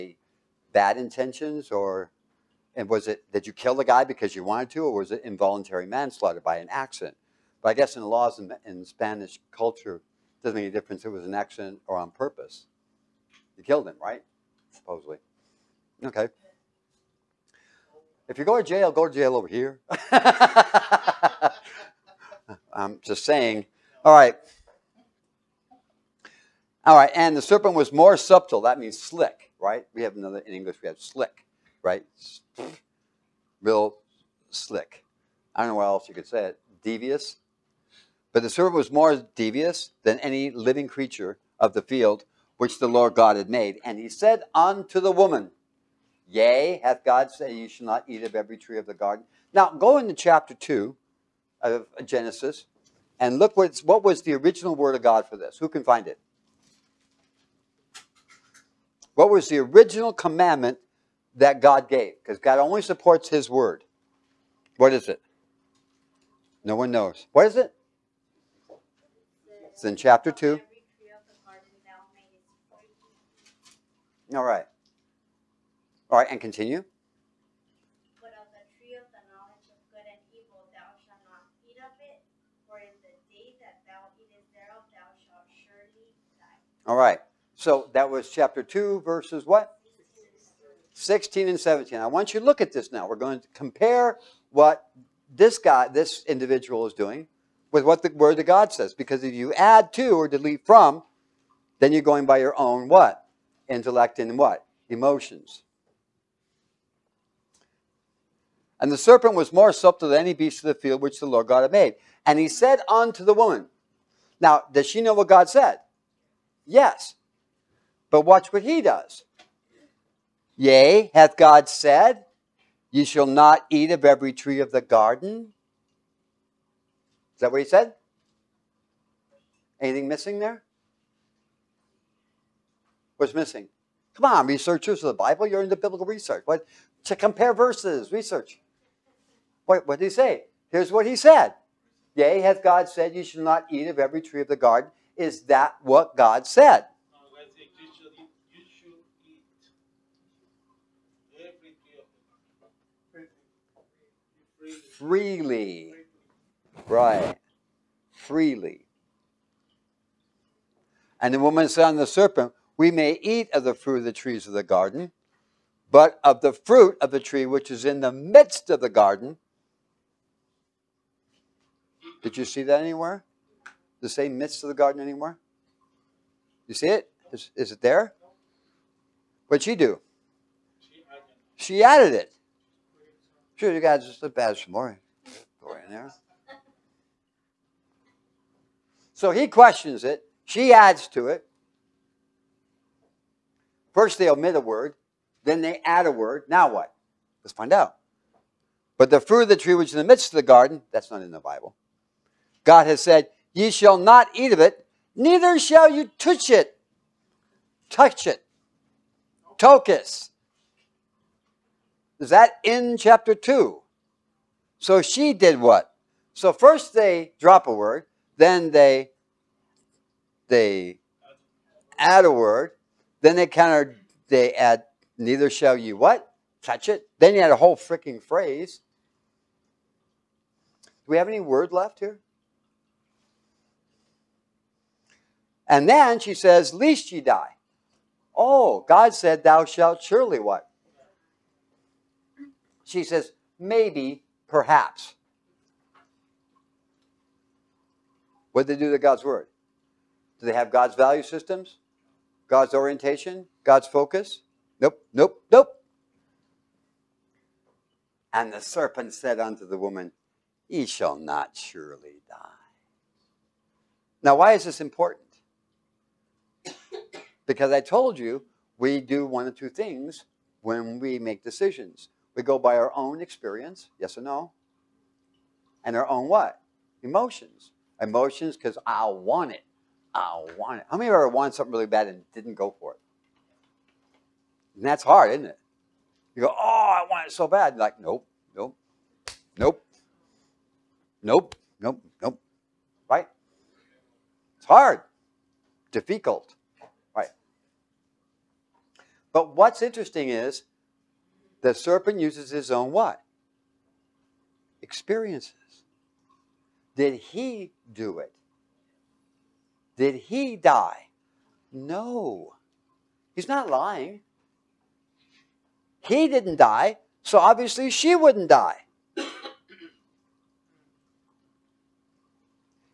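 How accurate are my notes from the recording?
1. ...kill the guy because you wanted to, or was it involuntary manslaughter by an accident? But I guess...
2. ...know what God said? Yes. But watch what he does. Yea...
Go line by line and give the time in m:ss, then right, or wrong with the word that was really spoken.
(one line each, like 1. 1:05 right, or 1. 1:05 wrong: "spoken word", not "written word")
1. 0:03 right
2. 1:55 right.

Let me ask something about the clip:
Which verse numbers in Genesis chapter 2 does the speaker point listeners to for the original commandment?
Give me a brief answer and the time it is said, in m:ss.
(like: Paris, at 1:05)
16 and 17, at 1:30.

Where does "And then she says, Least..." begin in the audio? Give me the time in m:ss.
3:55.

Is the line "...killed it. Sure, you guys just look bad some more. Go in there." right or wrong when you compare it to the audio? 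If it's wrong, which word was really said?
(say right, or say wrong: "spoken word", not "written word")
wrong: "added", not "killed".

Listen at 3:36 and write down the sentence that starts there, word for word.
So first they drop a word, then they they add a word, then they counter they add neither shall you what?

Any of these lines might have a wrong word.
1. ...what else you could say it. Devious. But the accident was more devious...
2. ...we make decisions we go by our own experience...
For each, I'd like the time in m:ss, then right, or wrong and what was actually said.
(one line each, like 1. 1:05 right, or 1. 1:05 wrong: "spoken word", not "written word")
1. 0:35 wrong: "serpent", not "accident"
2. 4:30 right.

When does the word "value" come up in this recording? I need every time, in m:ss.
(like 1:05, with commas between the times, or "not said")
4:10.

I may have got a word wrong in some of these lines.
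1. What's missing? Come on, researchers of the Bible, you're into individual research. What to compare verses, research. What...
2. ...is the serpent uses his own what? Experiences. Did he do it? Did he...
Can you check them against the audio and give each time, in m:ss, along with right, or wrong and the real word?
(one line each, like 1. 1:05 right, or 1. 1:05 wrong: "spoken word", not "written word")
1. 2:13 wrong: "biblical", not "individual"
2. 5:00 right.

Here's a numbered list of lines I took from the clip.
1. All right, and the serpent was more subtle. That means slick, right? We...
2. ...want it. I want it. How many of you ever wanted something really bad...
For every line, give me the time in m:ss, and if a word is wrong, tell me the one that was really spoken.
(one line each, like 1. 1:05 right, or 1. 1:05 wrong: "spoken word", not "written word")
1. 0:26 right
2. 4:39 right.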